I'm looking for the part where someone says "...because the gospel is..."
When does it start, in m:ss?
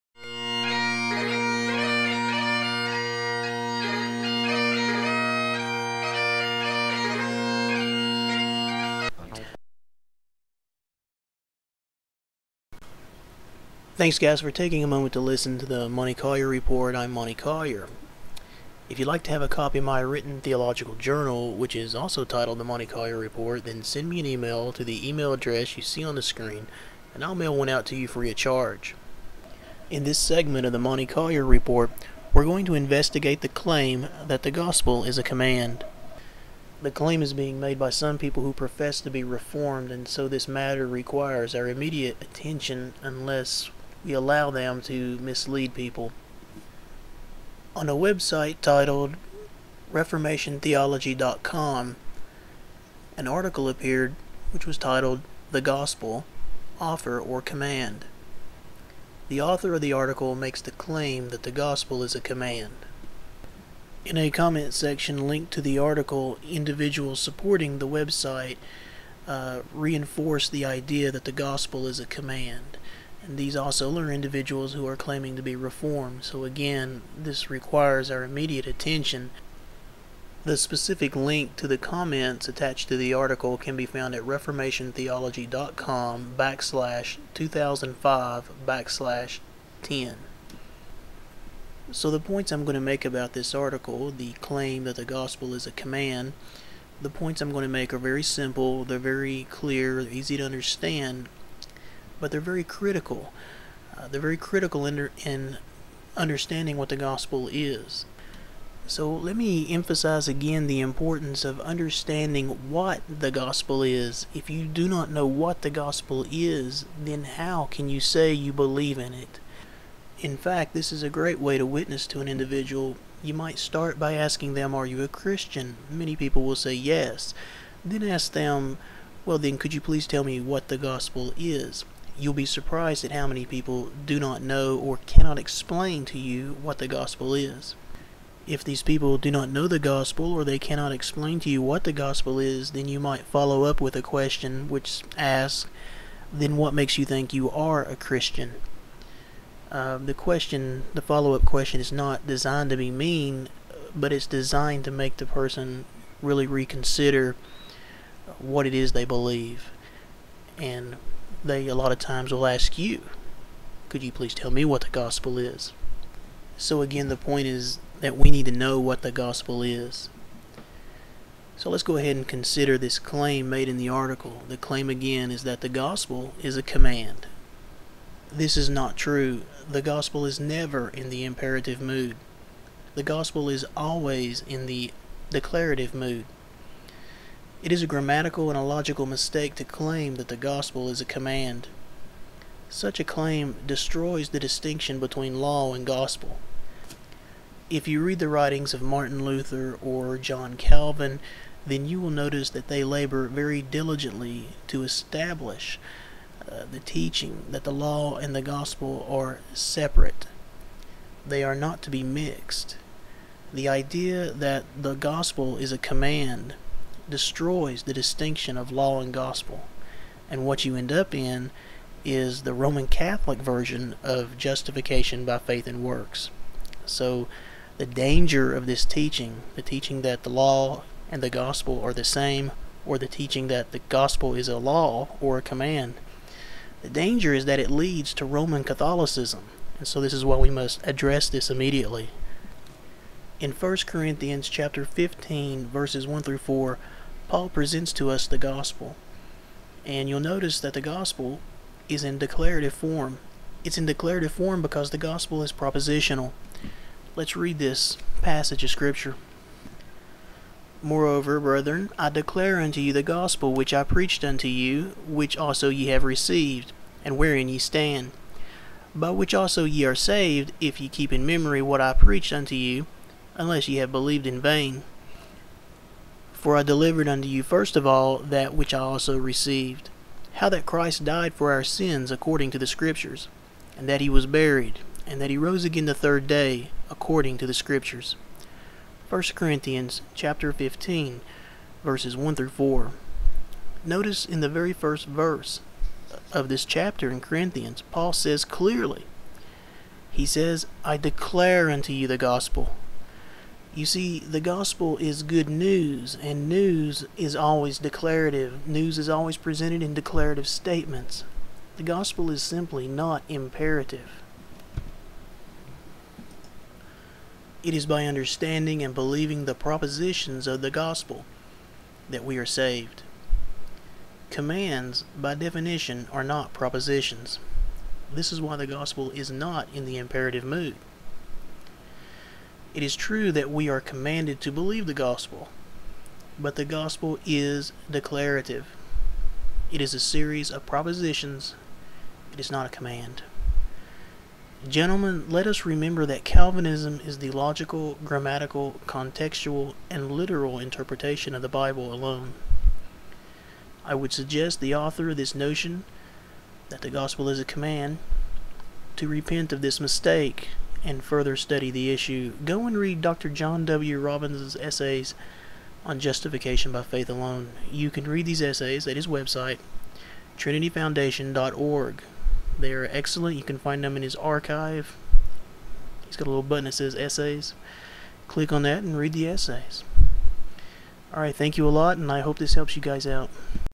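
4:14.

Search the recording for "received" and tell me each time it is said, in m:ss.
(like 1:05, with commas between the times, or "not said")
4:26, 4:39.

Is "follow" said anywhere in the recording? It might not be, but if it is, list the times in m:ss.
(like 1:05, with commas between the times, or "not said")
2:23, 2:31.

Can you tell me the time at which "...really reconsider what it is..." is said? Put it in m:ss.
2:36.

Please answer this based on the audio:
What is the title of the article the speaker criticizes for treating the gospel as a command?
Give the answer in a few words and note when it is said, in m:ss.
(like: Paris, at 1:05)
The Gospel Offer or Command, at 0:55.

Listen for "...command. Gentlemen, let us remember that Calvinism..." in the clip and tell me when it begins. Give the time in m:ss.
5:42.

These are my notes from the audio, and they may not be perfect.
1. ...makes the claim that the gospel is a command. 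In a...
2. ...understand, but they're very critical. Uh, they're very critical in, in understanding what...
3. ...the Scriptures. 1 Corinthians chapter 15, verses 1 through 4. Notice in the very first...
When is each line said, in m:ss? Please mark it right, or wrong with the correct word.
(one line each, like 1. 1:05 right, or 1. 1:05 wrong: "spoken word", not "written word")
1. 1:00 right
2. 1:40 right
3. 4:47 right.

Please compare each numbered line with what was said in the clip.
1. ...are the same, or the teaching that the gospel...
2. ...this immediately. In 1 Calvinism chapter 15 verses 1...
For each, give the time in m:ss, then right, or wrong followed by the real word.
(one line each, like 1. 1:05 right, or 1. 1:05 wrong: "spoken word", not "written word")
1. 3:51 right
2. 4:01 wrong: "Corinthians", not "Calvinism".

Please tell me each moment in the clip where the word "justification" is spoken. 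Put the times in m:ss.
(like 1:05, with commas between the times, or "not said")
3:44, 6:05.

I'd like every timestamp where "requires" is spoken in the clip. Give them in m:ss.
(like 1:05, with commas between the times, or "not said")
0:40, 1:17.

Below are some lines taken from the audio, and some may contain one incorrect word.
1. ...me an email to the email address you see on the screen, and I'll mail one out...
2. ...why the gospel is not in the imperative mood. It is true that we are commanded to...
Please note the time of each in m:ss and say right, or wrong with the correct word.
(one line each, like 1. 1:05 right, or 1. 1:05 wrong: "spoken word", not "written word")
1. 0:24 right
2. 5:28 right.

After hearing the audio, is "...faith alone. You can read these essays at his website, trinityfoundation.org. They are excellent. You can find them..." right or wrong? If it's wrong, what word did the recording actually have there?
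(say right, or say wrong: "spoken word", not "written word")
right.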